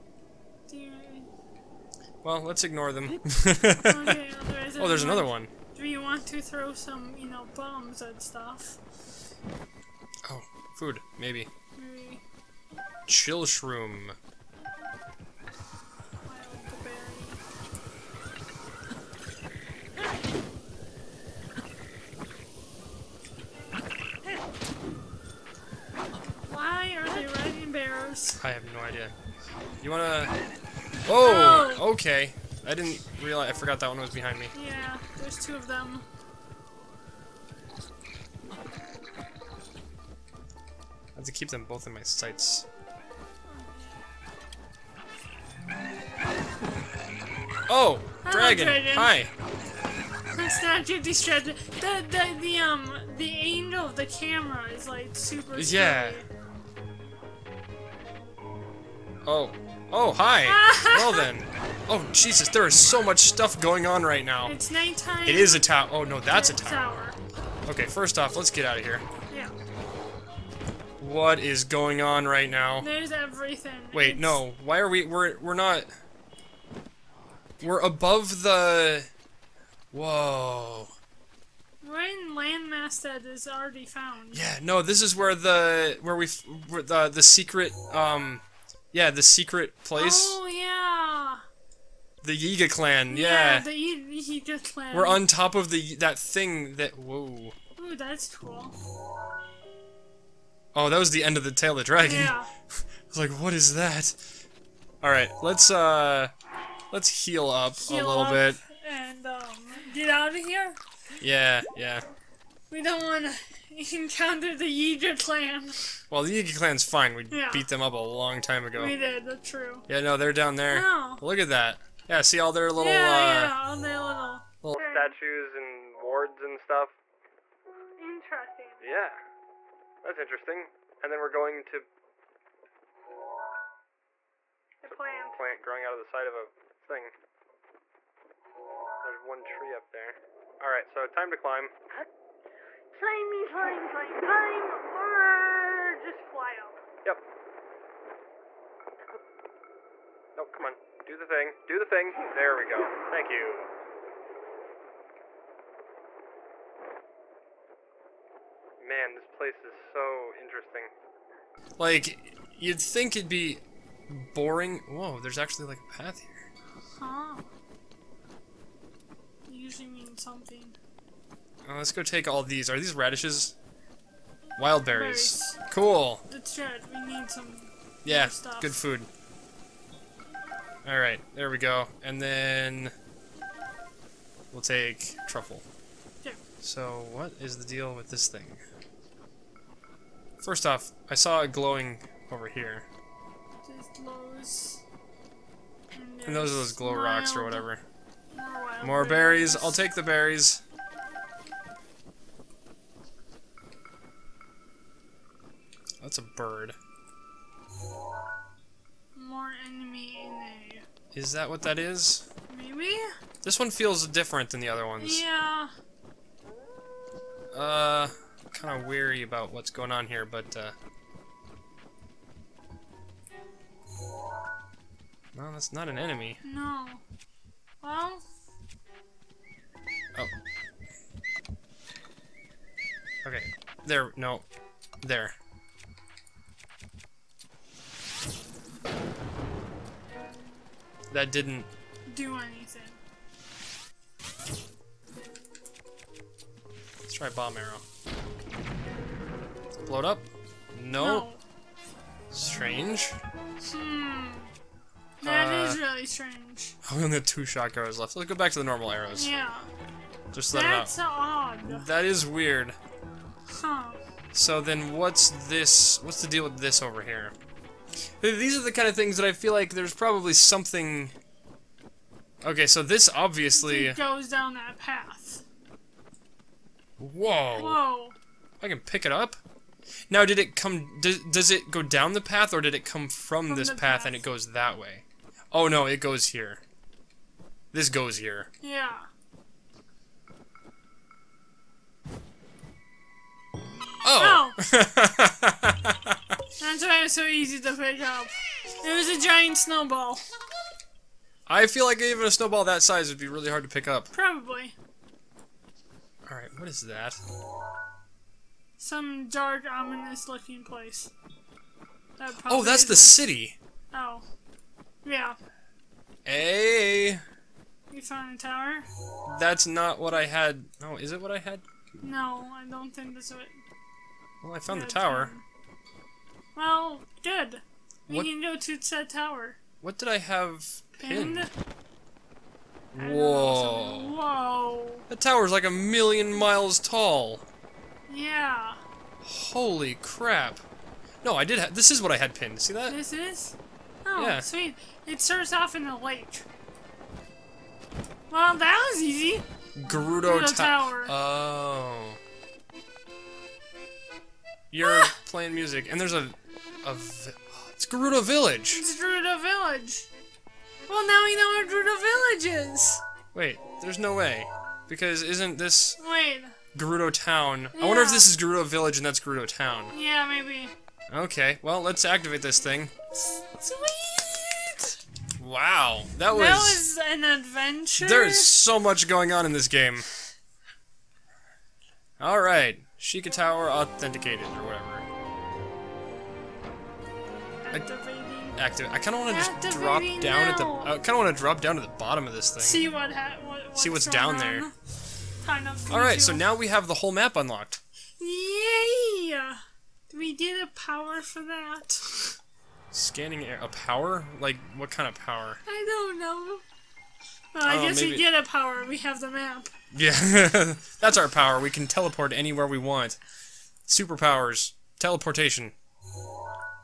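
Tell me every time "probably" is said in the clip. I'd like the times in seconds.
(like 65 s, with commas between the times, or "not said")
269 s, 304 s.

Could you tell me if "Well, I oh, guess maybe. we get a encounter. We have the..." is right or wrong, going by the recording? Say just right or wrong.
wrong.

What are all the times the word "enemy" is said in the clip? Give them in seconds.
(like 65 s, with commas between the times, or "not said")
209 s, 225 s.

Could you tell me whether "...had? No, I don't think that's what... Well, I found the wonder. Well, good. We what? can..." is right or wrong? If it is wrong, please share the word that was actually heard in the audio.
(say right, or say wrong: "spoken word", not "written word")
wrong: "tower", not "wonder".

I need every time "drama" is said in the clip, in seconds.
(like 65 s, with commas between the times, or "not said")
not said.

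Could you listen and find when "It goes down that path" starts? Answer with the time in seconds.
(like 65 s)
273 s.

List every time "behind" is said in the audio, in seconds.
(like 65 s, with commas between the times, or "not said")
34 s.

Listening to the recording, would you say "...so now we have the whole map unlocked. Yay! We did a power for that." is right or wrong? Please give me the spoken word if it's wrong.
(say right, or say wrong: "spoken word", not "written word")
right.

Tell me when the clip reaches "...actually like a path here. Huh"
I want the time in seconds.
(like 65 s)
165 s.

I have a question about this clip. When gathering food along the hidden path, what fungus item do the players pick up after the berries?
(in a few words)
Truffle.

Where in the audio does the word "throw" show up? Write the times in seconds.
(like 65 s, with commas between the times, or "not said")
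6 s.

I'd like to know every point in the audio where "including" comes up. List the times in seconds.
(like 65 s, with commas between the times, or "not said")
not said.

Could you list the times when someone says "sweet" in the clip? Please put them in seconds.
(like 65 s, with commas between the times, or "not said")
344 s, 373 s.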